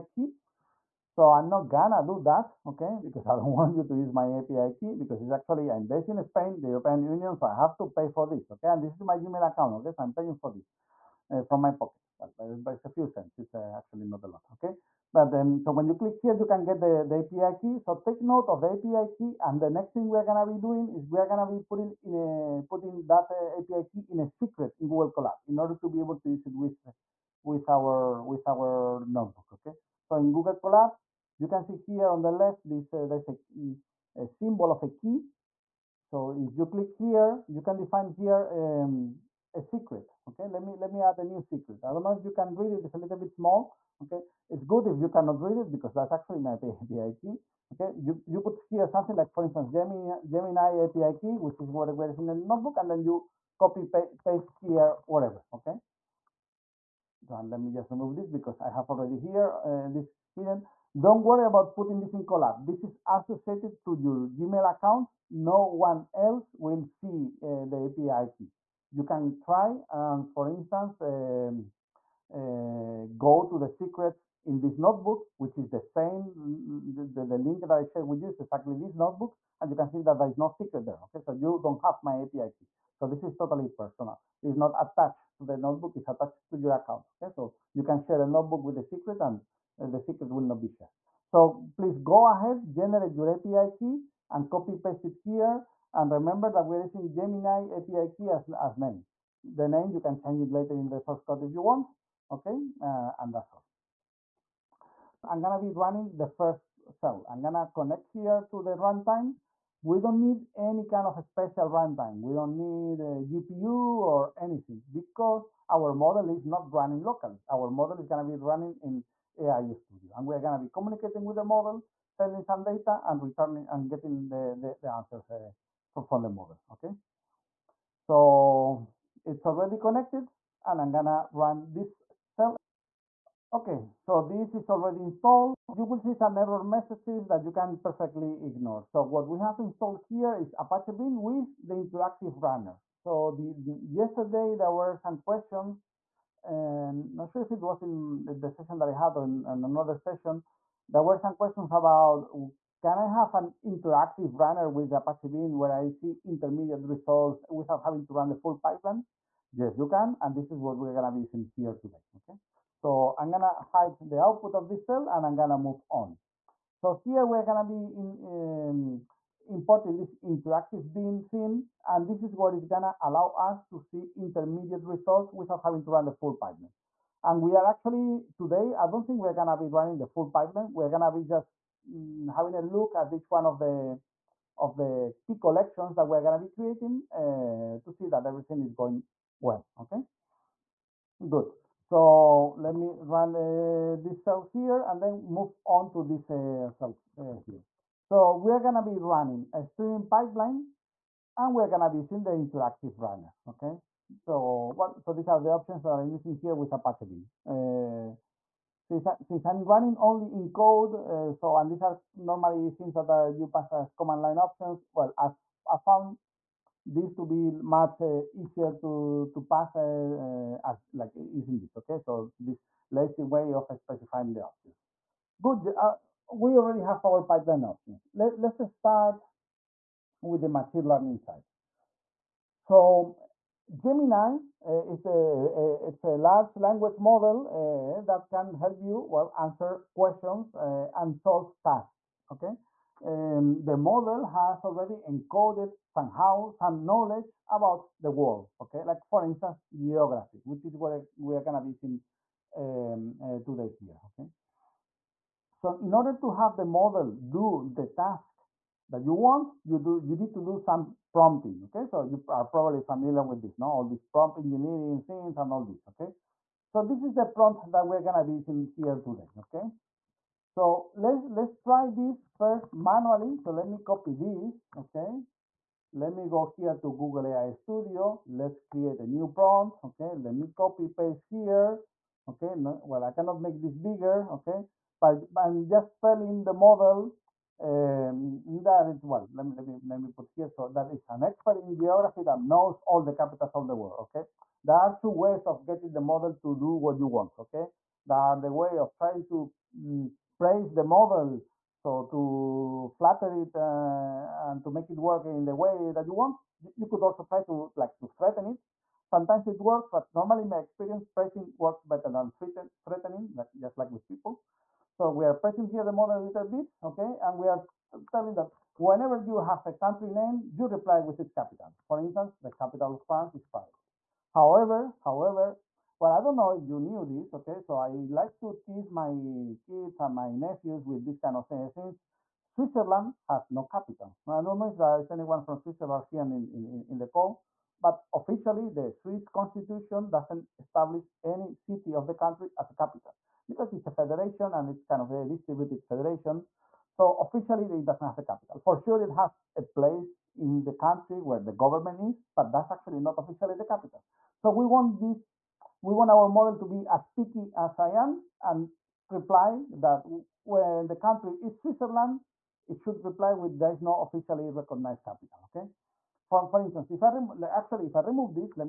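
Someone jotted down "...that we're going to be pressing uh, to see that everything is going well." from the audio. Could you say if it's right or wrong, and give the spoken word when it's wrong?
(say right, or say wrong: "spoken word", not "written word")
wrong: "creating", not "pressing".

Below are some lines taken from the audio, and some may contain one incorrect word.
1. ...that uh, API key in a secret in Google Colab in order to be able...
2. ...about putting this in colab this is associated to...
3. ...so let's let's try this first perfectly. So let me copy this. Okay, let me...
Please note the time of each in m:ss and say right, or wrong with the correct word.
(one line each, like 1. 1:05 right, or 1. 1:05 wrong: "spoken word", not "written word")
1. 0:23 right
2. 1:01 right
3. 4:30 wrong: "manually", not "perfectly".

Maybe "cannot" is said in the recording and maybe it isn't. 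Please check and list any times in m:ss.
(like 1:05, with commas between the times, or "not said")
0:45, 4:43.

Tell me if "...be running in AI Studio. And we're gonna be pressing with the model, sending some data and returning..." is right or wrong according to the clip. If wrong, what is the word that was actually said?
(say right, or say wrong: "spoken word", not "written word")
wrong: "communicating", not "pressing".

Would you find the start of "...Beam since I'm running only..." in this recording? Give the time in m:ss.
3:27.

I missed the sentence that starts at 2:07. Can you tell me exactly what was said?
So it's already connected and I'm gonna run this cell.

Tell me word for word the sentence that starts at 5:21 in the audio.
For instance, the capital of France is Paris.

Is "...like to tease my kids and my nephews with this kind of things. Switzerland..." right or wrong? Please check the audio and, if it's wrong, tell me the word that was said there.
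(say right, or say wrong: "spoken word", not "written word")
right.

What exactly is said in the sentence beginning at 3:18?
So we're going to be running a streaming pipeline and we're going to be using the interactive runner.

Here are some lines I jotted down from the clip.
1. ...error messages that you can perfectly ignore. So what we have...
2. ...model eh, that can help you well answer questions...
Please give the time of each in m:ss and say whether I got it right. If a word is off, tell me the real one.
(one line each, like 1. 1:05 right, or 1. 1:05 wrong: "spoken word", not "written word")
1. 2:16 right
2. 3:56 right.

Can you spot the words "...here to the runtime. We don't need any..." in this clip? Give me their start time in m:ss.
1:48.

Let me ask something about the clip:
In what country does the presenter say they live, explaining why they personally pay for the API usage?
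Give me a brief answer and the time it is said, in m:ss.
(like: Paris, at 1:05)
Spain, at 0:06.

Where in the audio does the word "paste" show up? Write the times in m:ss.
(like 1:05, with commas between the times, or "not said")
0:54, 1:34, 4:40.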